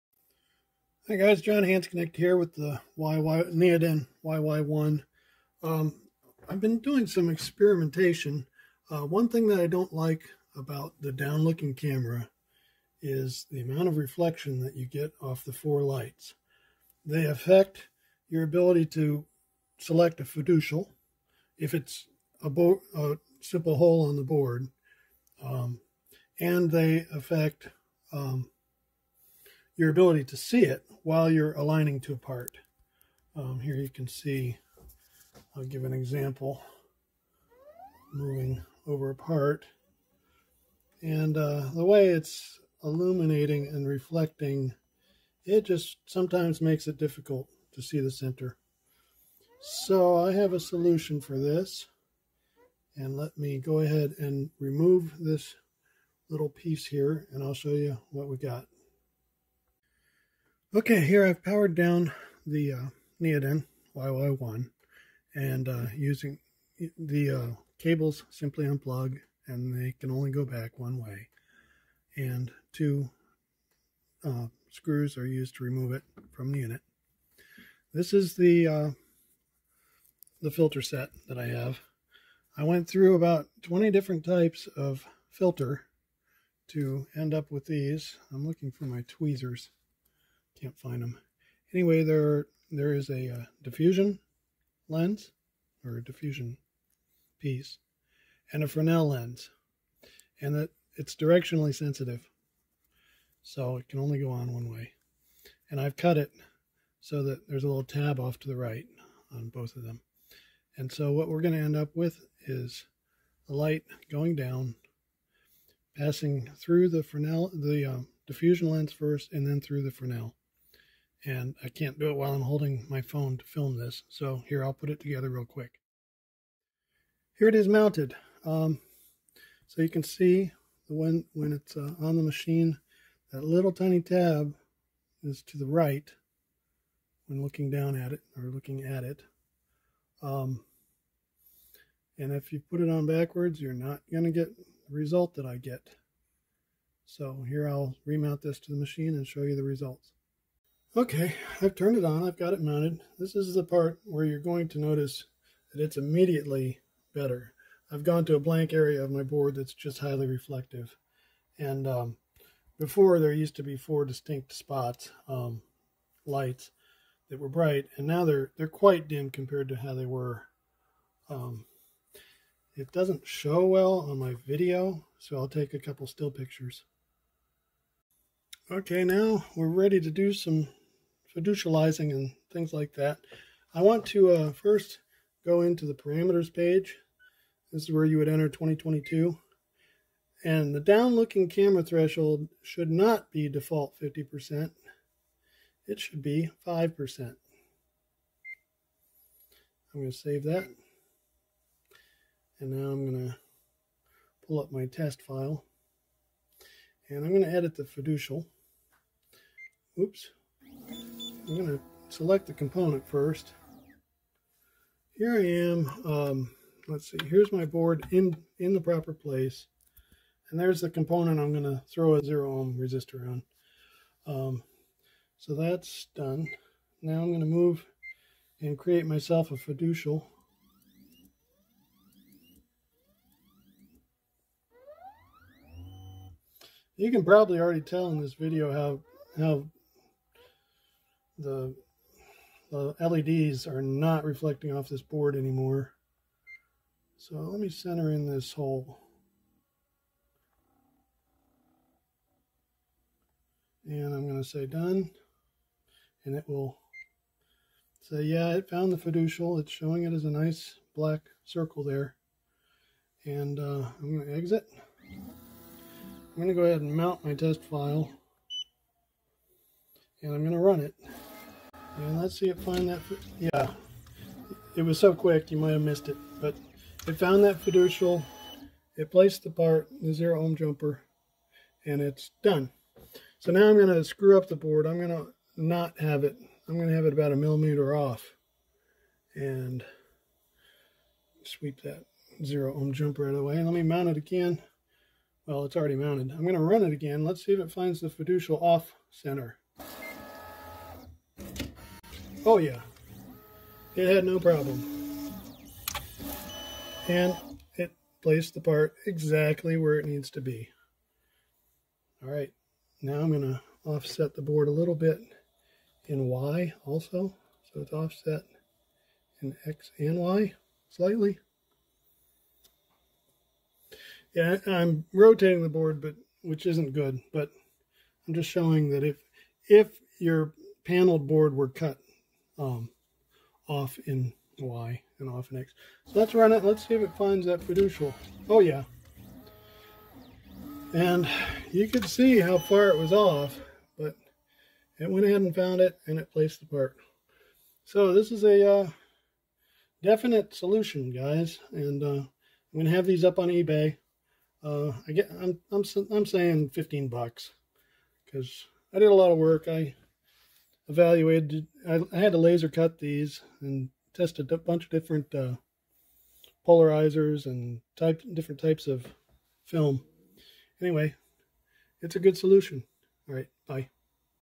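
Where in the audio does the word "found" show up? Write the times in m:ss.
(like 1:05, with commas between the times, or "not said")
4:18, 4:37, 5:45.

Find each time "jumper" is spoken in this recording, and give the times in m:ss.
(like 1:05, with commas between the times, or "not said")
4:40, 4:52.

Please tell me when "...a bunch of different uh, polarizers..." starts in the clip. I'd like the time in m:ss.
6:04.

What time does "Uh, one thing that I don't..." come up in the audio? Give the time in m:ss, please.
0:08.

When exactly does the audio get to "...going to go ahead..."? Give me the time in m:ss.
4:26.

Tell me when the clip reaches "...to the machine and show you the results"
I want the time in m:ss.
2:28.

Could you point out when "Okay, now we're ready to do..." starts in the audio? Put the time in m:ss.
2:58.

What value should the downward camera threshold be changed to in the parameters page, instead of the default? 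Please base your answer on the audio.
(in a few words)
5%.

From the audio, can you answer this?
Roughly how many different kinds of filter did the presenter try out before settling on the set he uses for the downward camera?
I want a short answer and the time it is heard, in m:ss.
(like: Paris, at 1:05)
20, at 1:23.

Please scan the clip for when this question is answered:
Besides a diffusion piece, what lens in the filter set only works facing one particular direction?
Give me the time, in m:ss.
1:38.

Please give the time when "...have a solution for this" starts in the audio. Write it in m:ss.
0:50.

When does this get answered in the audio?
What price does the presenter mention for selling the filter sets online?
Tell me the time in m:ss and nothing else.
5:56.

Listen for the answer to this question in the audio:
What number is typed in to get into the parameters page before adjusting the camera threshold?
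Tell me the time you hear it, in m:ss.
3:08.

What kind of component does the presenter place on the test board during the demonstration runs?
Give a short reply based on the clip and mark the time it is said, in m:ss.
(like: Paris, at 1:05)
zero ohm resistor, at 3:42.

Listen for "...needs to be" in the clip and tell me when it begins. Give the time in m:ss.
5:10.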